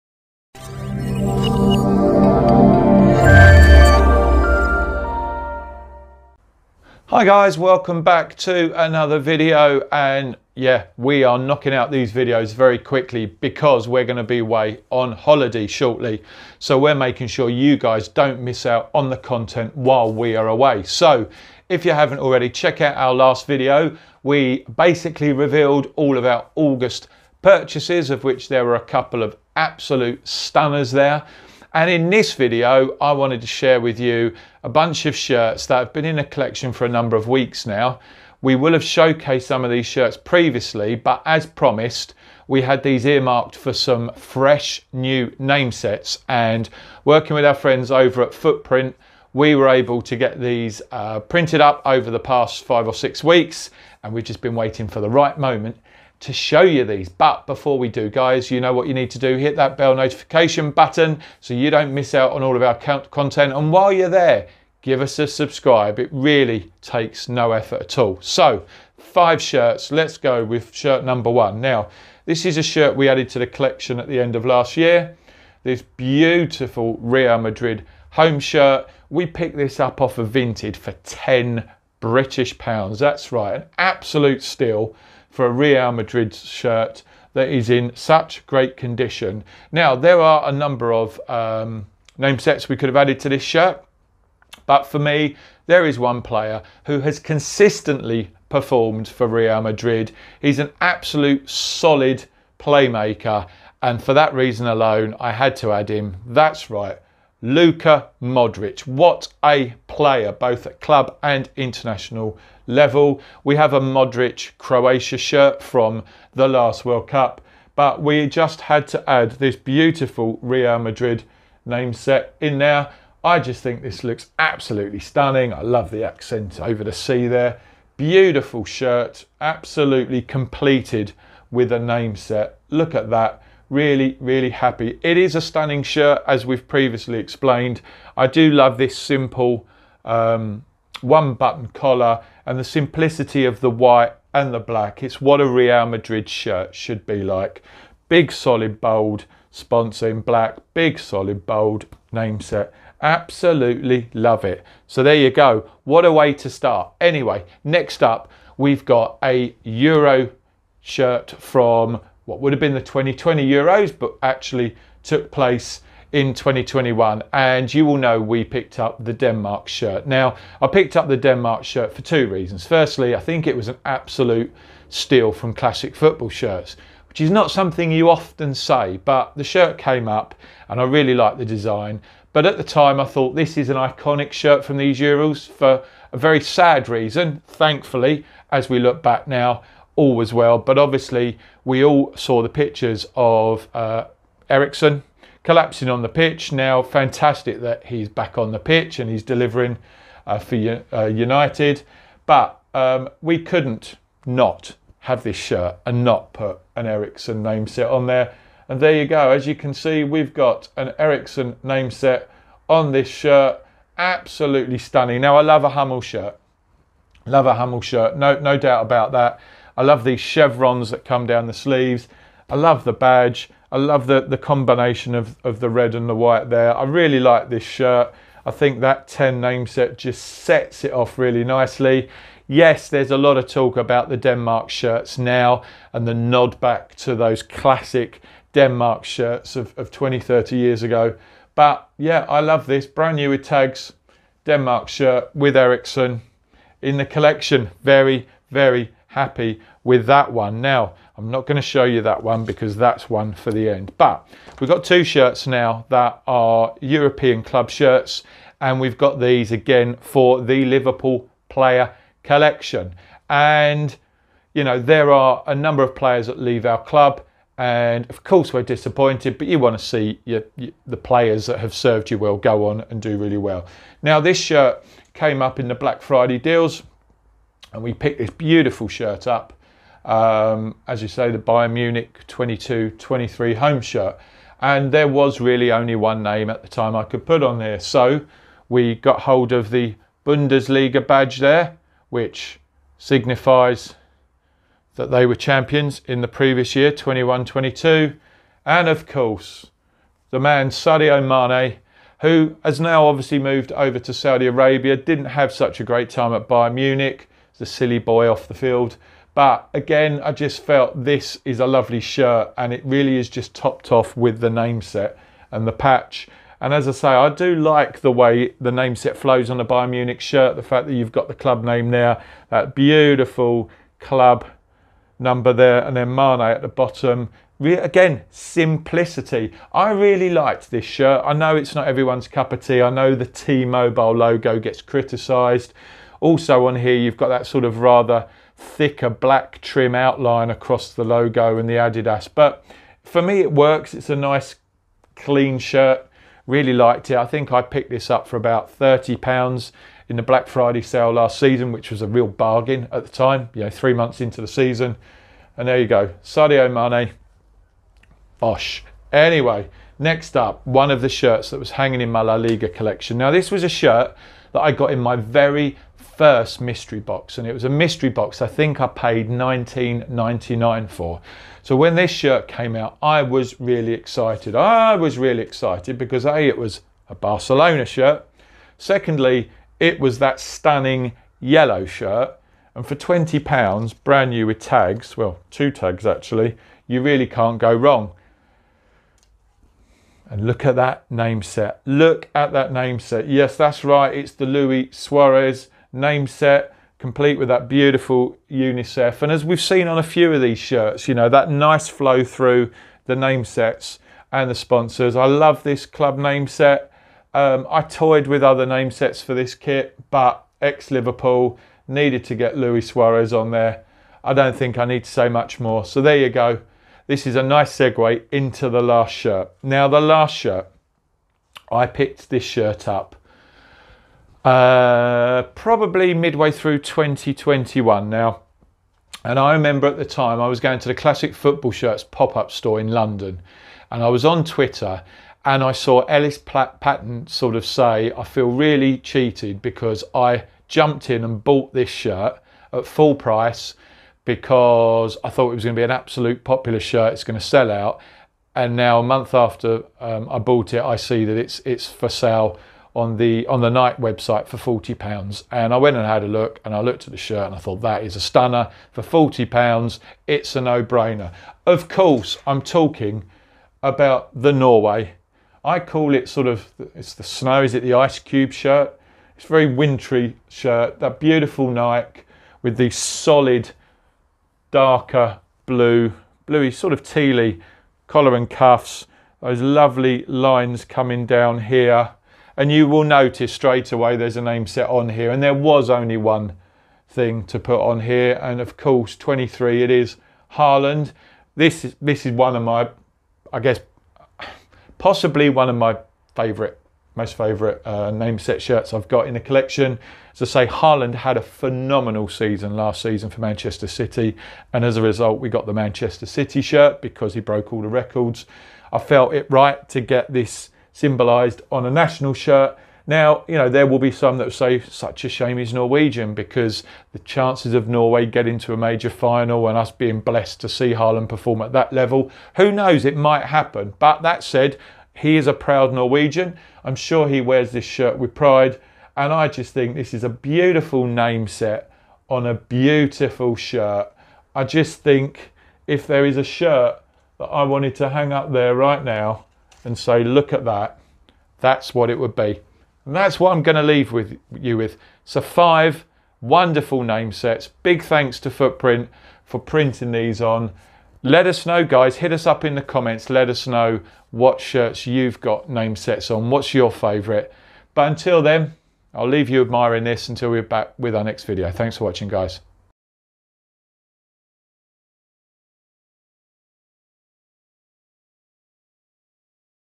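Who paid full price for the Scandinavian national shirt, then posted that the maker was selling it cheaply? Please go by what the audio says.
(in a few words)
Ellis Platten.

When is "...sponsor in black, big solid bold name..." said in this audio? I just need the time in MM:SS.
02:29.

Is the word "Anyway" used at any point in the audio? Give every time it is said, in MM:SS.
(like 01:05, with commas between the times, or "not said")
02:37, 05:59.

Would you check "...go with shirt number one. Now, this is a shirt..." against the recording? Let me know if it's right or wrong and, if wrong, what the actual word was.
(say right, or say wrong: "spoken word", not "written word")
right.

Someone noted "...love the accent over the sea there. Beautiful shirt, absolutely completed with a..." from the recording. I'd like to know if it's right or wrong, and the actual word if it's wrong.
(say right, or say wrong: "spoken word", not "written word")
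right.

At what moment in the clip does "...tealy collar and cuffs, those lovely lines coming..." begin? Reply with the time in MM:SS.
07:57.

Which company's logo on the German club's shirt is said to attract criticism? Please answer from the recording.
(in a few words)
T-Mobile.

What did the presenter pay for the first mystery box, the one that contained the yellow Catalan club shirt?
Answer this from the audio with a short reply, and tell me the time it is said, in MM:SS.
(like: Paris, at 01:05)
£19.99, at 06:09.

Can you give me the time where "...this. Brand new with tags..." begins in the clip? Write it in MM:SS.
04:02.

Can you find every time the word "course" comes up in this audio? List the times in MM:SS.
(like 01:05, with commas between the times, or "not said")
04:28, 04:59, 07:41, 08:08.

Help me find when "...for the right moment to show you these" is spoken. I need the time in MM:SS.
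00:54.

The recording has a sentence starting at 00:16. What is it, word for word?
So we're making sure you guys don't miss out on the content while we are away.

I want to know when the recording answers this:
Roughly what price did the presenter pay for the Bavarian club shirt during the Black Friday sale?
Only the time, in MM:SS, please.
05:48.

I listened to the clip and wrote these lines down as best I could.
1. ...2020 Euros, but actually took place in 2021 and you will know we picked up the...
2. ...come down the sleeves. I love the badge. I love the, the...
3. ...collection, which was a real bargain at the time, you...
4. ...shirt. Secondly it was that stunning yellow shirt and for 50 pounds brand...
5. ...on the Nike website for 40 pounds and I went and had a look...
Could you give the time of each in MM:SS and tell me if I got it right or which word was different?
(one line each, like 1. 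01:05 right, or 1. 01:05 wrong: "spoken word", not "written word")
1. 02:42 right
2. 03:41 right
3. 05:51 wrong: "season", not "collection"
4. 06:17 wrong: "20", not "50"
5. 07:33 right.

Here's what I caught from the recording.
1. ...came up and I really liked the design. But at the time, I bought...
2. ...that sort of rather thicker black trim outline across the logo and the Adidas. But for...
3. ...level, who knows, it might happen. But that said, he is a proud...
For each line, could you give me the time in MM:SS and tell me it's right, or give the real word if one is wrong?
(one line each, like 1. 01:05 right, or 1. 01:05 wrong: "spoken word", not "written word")
1. 02:59 wrong: "thought", not "bought"
2. 05:37 right
3. 08:41 right.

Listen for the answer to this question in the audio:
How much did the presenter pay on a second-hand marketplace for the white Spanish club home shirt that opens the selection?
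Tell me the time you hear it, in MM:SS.
01:21.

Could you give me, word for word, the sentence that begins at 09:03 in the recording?
And that's what I'm going to leave with you with.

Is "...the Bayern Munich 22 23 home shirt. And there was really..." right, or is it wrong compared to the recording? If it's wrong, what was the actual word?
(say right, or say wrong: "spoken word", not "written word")
right.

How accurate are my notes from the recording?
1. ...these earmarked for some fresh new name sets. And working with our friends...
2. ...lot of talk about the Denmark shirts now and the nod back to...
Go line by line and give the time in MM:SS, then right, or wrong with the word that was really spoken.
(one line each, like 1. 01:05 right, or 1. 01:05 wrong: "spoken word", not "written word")
1. 00:42 right
2. 03:53 right.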